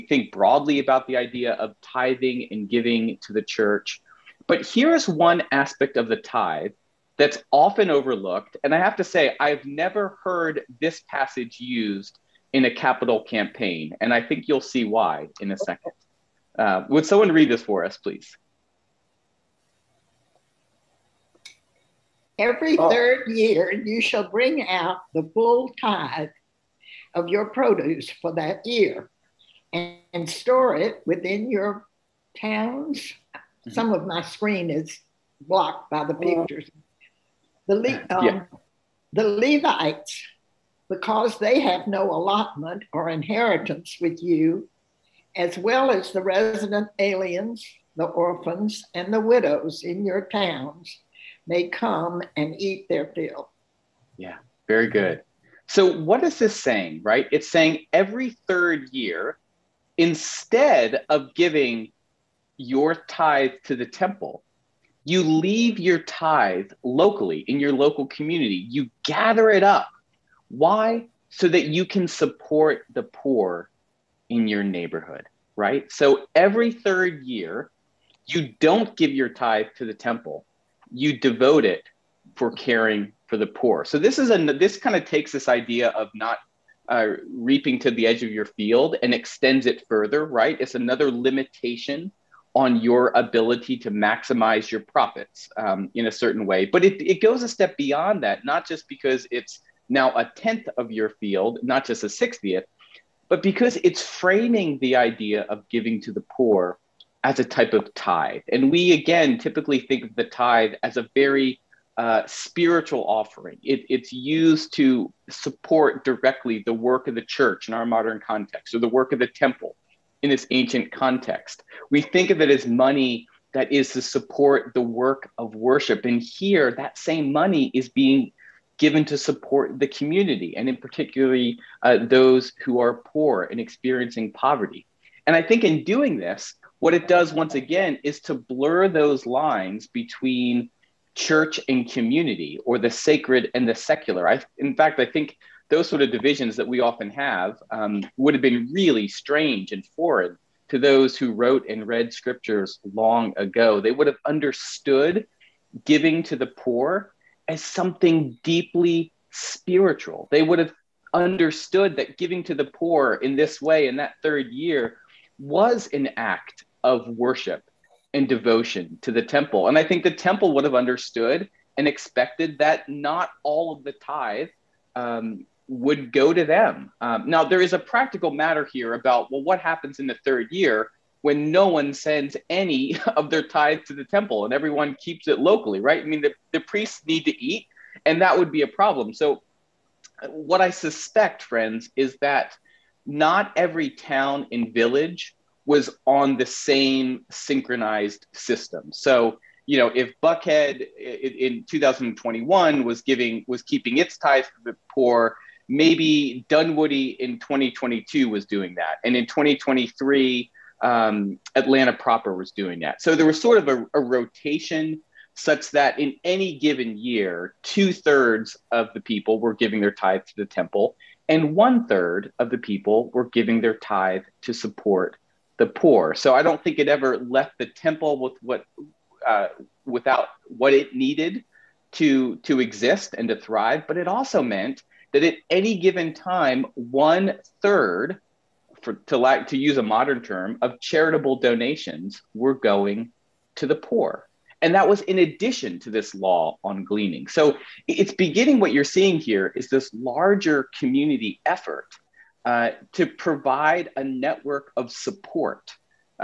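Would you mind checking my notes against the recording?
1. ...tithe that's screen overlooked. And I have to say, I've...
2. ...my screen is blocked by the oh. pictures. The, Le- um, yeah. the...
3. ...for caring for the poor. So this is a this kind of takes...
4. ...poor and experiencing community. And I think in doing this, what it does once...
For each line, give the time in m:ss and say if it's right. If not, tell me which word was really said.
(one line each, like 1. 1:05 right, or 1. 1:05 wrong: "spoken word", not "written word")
1. 0:06 wrong: "often", not "screen"
2. 0:34 right
3. 1:22 right
4. 2:13 wrong: "poverty", not "community".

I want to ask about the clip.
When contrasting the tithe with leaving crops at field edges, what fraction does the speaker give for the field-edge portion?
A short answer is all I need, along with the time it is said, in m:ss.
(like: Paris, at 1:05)
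a 60th, at 1:42.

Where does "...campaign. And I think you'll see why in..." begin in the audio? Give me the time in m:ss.
0:13.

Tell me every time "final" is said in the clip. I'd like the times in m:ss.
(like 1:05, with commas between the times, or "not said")
not said.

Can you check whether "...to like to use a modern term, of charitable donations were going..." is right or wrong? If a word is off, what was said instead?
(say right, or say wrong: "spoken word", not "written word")
right.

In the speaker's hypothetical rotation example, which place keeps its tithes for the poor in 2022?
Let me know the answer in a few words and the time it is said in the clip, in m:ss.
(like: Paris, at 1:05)
Dunwoody, at 3:26.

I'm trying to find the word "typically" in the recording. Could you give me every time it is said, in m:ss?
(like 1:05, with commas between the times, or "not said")
1:49.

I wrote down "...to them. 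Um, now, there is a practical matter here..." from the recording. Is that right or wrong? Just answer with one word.
right.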